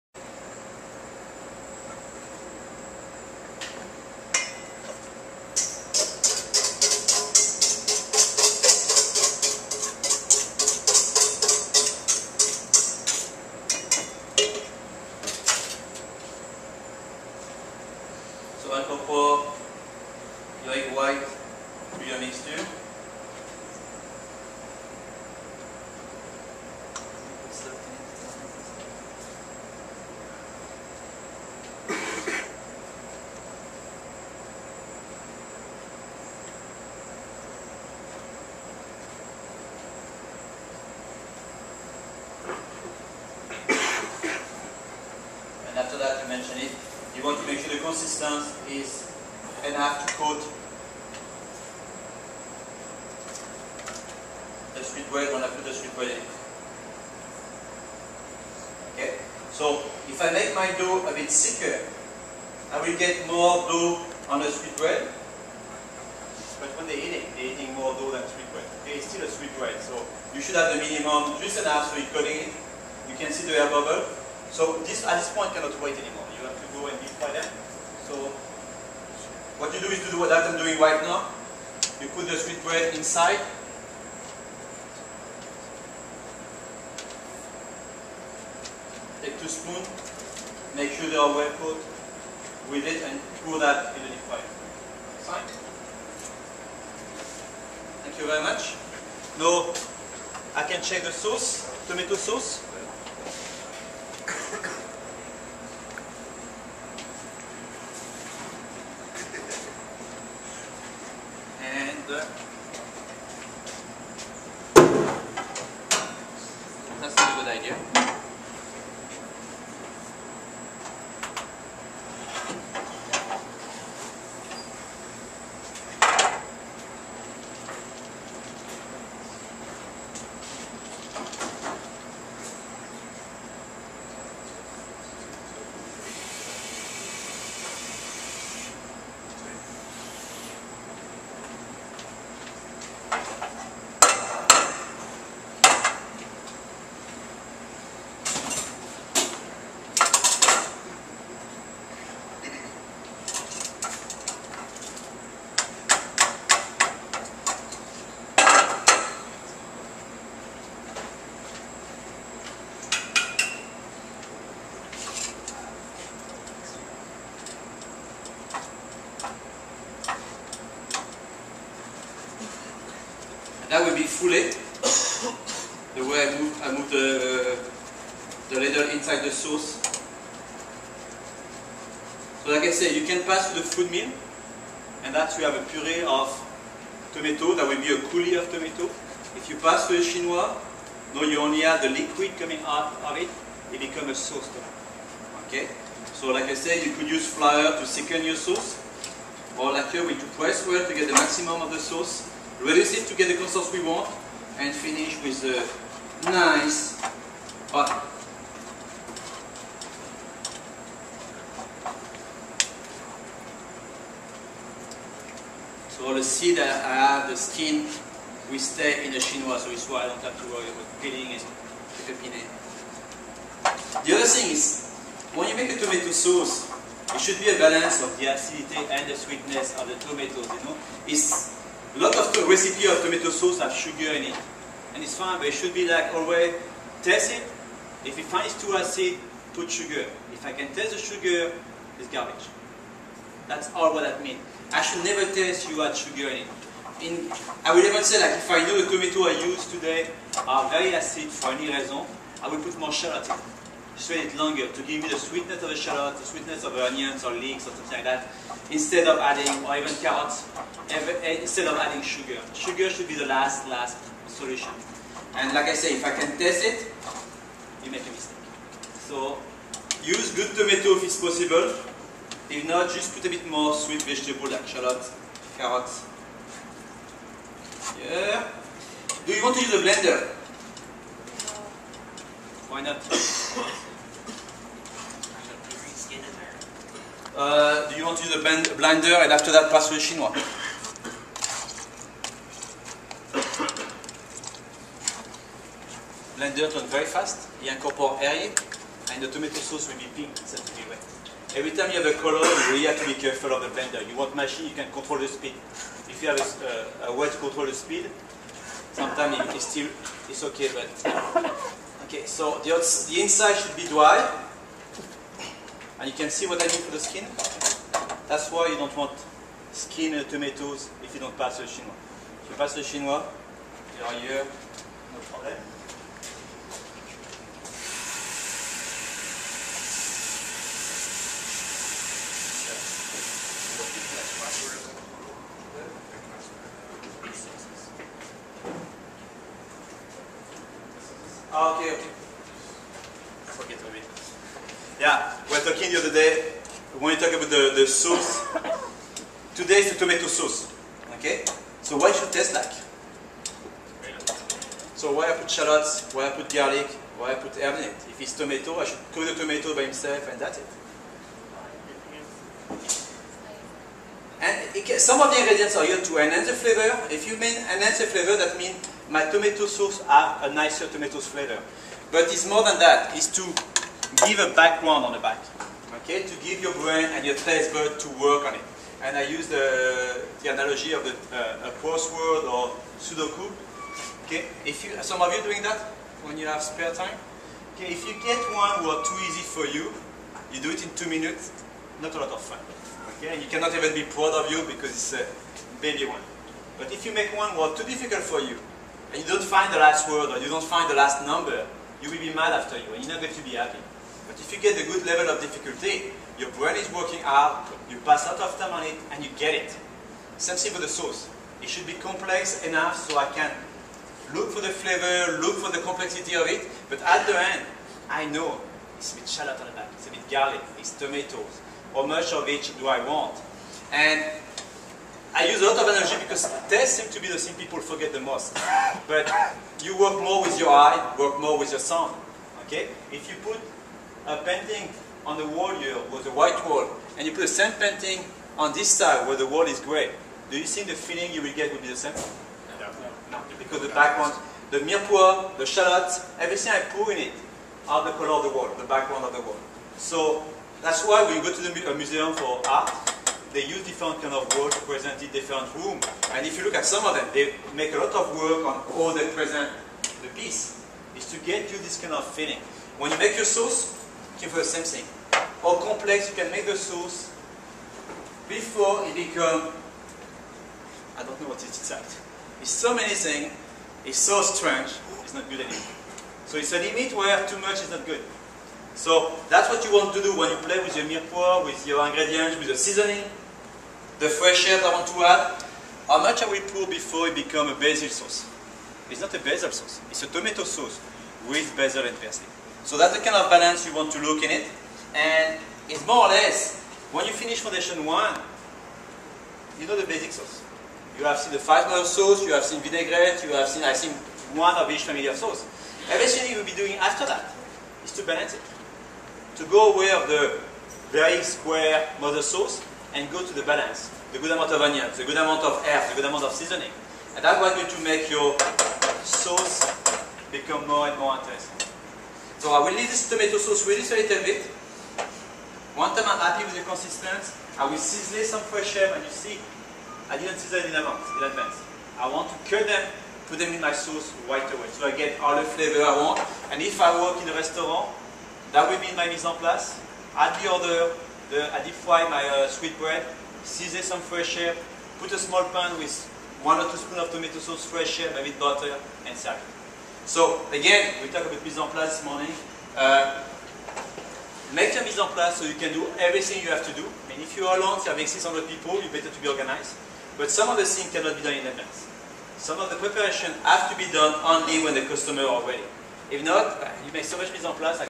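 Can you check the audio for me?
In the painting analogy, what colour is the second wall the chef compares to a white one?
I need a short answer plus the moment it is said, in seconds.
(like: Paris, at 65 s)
gray, at 439 s.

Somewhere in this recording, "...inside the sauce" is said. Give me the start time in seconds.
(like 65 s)
178 s.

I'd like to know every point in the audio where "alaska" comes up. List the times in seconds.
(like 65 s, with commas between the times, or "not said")
not said.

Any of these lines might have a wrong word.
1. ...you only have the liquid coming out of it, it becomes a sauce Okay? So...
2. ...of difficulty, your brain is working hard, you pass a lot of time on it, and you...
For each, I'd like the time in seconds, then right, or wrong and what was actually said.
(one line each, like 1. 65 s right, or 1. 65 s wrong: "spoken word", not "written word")
1. 191 s right
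2. 405 s right.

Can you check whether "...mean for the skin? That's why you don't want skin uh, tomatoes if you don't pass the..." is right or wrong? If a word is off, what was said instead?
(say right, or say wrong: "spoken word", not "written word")
right.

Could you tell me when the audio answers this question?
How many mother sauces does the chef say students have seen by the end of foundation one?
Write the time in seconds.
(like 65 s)
501 s.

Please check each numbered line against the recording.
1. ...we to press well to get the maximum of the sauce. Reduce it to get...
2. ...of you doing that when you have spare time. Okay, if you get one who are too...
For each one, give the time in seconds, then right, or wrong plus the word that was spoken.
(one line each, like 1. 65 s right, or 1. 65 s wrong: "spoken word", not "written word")
1. 200 s right
2. 385 s right.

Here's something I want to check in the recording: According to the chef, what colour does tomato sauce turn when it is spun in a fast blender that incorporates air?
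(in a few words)
pink.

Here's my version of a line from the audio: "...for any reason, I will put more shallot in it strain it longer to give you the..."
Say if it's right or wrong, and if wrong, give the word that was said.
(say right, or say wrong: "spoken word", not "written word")
right.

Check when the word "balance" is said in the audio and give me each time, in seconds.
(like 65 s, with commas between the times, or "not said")
227 s, 493 s, 508 s, 513 s.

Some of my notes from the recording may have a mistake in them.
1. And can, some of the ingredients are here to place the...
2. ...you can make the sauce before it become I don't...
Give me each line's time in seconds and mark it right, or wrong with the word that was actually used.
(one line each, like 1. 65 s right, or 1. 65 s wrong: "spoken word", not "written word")
1. 364 s wrong: "enhance", not "place"
2. 466 s right.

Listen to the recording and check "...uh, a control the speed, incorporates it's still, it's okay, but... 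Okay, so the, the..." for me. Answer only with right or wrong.
wrong.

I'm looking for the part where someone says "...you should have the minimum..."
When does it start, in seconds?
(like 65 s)
70 s.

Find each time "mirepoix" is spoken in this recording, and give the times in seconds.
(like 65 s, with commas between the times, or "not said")
444 s, 481 s.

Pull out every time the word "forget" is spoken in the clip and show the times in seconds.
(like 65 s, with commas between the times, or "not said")
343 s, 427 s.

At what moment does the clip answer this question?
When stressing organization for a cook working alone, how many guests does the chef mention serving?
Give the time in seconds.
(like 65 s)
558 s.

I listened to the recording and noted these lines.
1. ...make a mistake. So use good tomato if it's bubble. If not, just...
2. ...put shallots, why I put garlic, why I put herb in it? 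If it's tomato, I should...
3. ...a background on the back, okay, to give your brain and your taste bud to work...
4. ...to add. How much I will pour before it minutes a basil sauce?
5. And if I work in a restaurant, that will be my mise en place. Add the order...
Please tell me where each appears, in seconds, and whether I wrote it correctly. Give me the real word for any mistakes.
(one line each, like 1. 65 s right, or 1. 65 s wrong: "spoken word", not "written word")
1. 267 s wrong: "possible", not "bubble"
2. 355 s right
3. 374 s right
4. 485 s wrong: "becomes", not "minutes"
5. 536 s right.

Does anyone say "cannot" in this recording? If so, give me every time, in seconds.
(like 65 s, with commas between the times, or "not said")
75 s, 393 s, 561 s.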